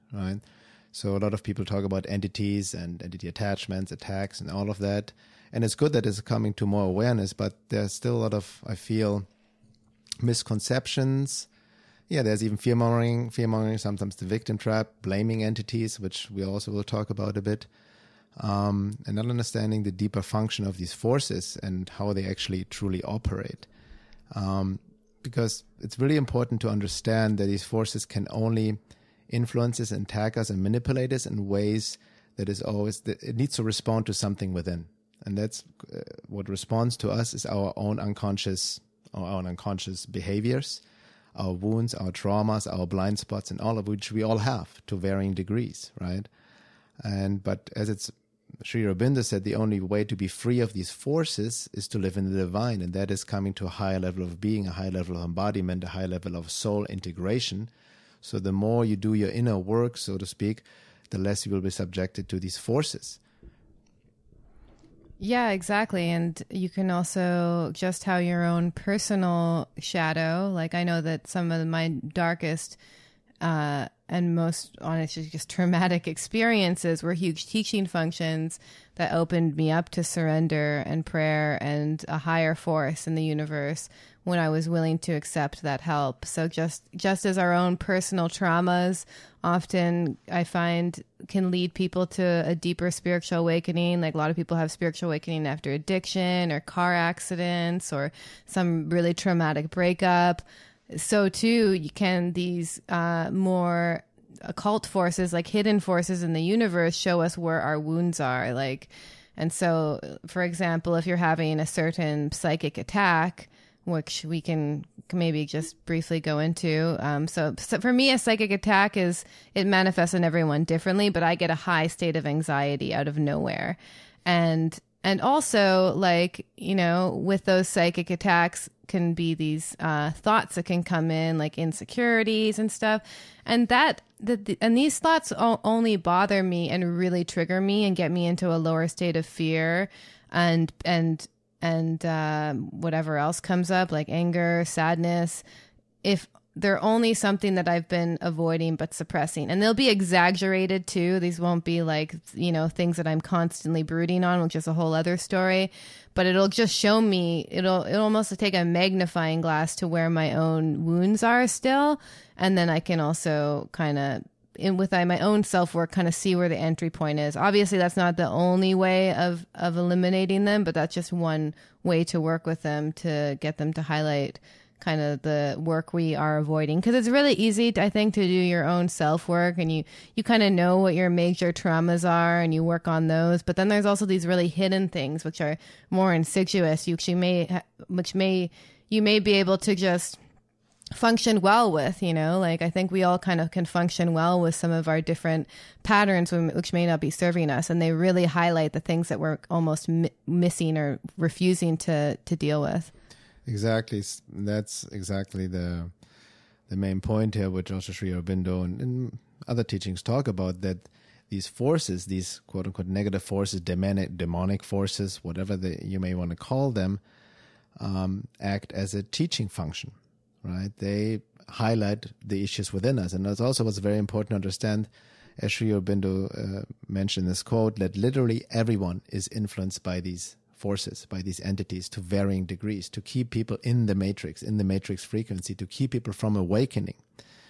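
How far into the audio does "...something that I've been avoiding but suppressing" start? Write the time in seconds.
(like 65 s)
147 s.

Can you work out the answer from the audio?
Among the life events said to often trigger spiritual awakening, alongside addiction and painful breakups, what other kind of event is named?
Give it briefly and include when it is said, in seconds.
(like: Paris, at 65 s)
car accidents, at 96 s.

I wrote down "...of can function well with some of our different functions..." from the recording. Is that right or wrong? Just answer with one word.
wrong.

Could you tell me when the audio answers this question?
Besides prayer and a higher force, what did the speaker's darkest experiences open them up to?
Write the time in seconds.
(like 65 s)
80 s.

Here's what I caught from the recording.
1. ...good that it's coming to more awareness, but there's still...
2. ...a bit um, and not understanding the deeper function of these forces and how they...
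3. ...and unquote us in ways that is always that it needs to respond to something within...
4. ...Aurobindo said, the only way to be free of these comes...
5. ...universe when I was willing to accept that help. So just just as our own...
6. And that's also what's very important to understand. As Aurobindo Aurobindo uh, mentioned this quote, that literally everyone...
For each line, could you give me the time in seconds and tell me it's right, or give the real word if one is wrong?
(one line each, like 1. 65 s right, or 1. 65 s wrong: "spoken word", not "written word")
1. 5 s right
2. 17 s right
3. 30 s wrong: "manipulate", not "unquote"
4. 48 s wrong: "forces", not "comes"
5. 83 s right
6. 223 s wrong: "Sri", not "Aurobindo".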